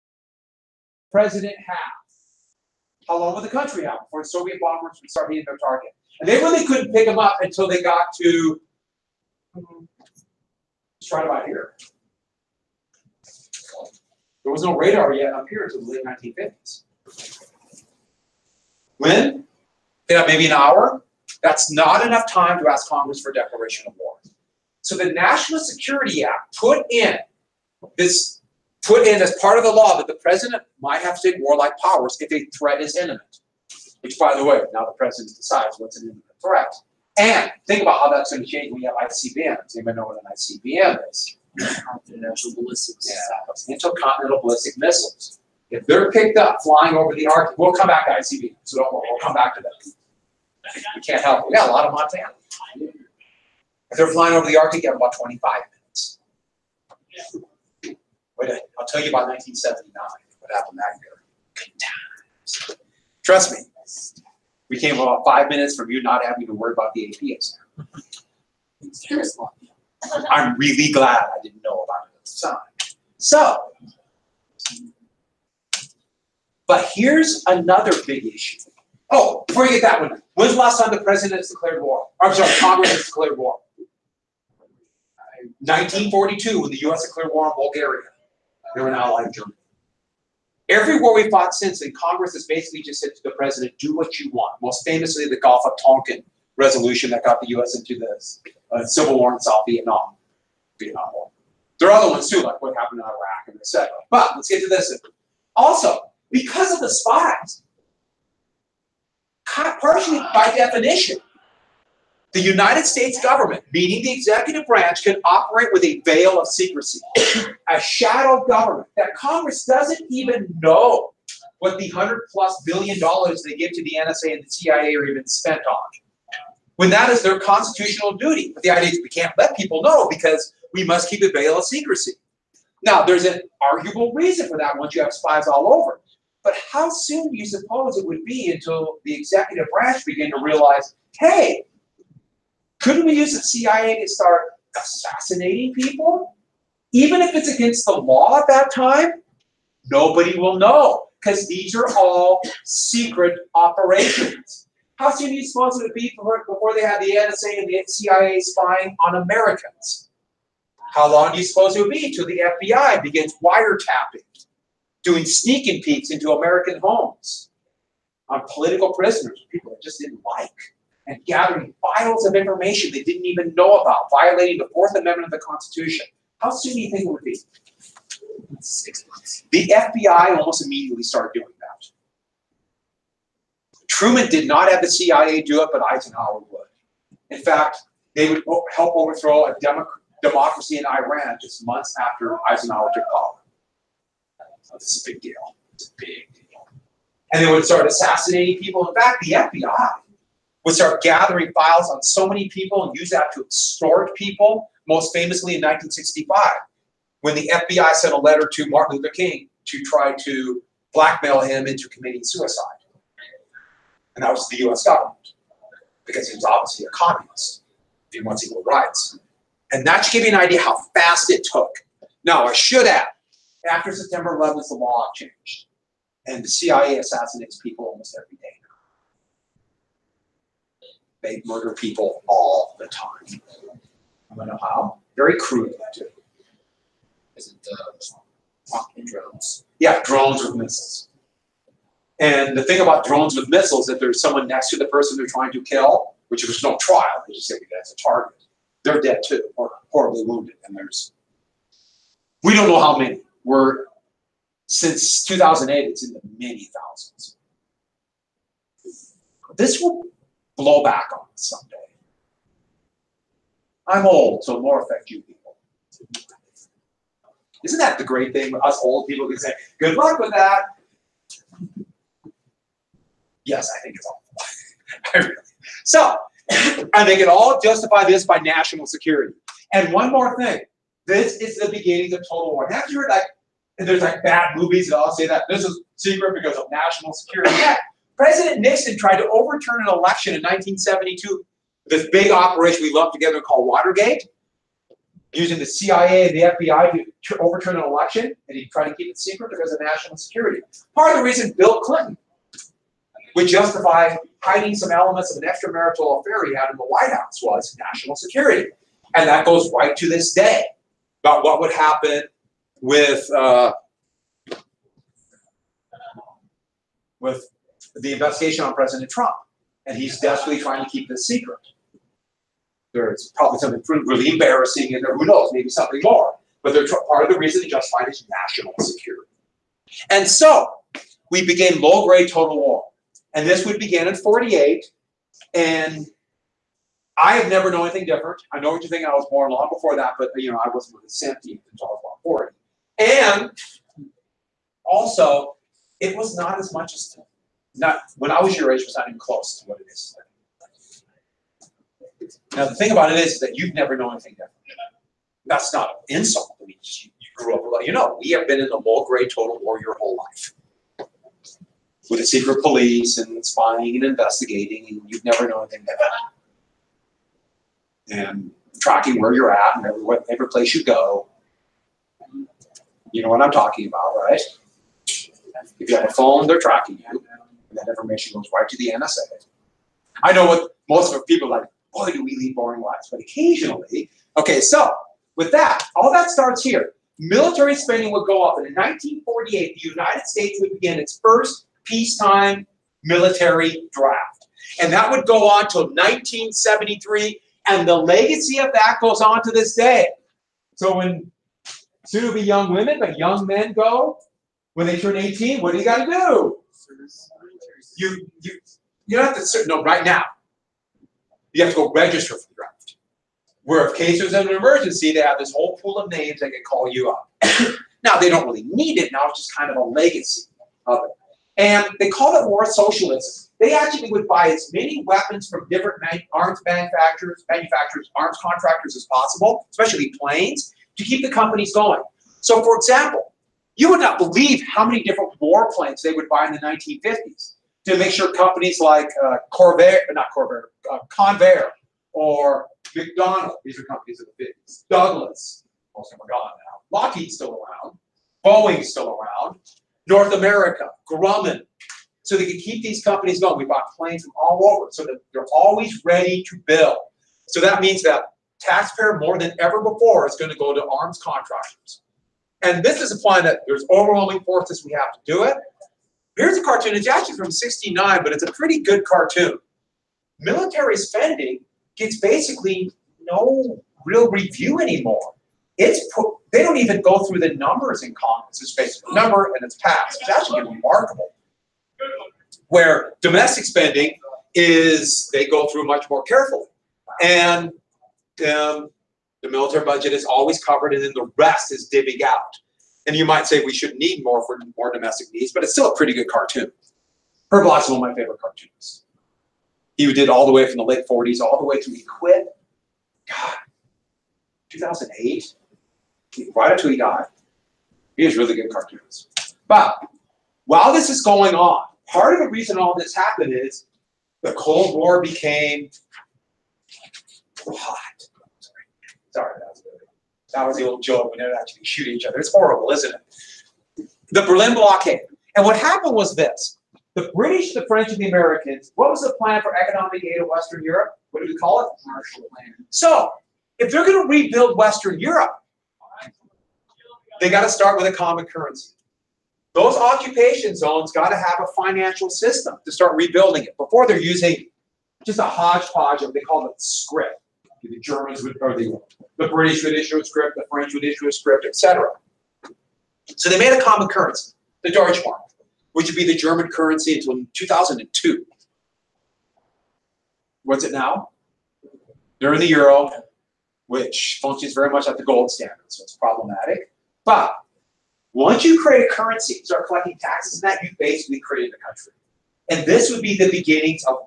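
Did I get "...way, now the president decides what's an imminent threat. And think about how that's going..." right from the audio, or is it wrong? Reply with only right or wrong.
right.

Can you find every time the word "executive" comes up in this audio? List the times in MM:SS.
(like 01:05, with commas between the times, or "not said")
01:54, 02:19.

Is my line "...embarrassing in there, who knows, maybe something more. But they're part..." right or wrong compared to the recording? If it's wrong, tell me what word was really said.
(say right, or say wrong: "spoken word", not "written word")
right.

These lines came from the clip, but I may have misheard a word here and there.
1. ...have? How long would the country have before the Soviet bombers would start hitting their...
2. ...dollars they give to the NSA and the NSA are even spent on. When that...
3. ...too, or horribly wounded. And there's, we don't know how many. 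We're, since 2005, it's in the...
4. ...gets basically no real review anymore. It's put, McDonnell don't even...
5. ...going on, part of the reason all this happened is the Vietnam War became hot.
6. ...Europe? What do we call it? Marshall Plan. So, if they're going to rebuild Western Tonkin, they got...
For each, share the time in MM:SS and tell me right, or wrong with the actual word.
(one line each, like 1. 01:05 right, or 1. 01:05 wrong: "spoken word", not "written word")
1. 00:01 right
2. 02:02 wrong: "CIA", not "NSA"
3. 04:09 wrong: "2008", not "2005"
4. 07:51 wrong: "They", not "McDonnell"
5. 08:31 wrong: "Cold", not "Vietnam"
6. 08:50 wrong: "Europe", not "Tonkin".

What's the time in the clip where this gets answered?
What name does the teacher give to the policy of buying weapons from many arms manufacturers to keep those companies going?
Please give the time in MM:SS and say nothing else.
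07:02.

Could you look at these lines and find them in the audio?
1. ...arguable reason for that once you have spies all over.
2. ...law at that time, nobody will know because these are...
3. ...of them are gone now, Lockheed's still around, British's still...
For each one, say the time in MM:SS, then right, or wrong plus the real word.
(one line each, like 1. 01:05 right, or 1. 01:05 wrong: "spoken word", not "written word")
1. 02:13 right
2. 02:27 right
3. 07:26 wrong: "Boeing", not "British".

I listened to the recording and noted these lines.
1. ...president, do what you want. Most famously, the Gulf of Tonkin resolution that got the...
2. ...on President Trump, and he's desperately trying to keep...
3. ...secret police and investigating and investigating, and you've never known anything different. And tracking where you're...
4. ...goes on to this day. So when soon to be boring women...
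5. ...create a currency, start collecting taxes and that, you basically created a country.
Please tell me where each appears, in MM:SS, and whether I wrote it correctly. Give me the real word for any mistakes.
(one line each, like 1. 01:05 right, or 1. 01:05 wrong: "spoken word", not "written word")
1. 01:33 right
2. 05:18 right
3. 06:02 wrong: "spying", not "investigating"
4. 06:38 wrong: "young", not "boring"
5. 09:28 right.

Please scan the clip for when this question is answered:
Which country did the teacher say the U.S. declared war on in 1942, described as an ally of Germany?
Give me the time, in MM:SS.
01:27.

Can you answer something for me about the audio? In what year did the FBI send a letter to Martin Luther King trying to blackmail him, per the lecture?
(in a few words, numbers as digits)
1965.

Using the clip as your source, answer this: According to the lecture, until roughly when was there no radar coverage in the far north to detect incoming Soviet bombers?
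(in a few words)
late 1950s.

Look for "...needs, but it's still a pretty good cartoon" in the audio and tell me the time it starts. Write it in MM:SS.
08:15.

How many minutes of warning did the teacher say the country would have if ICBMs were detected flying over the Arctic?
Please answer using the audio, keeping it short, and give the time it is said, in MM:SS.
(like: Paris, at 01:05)
25, at 00:55.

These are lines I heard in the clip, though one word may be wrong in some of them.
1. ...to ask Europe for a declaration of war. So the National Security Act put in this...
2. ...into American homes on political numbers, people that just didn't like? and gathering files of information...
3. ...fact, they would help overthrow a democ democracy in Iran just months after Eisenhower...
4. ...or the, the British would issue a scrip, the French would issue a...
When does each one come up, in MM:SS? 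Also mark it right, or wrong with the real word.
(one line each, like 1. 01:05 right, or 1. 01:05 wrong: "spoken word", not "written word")
1. 00:22 wrong: "Congress", not "Europe"
2. 02:46 wrong: "prisoners", not "numbers"
3. 03:07 right
4. 09:08 right.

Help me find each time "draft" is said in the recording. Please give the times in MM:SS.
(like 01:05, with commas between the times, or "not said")
06:33, 06:52.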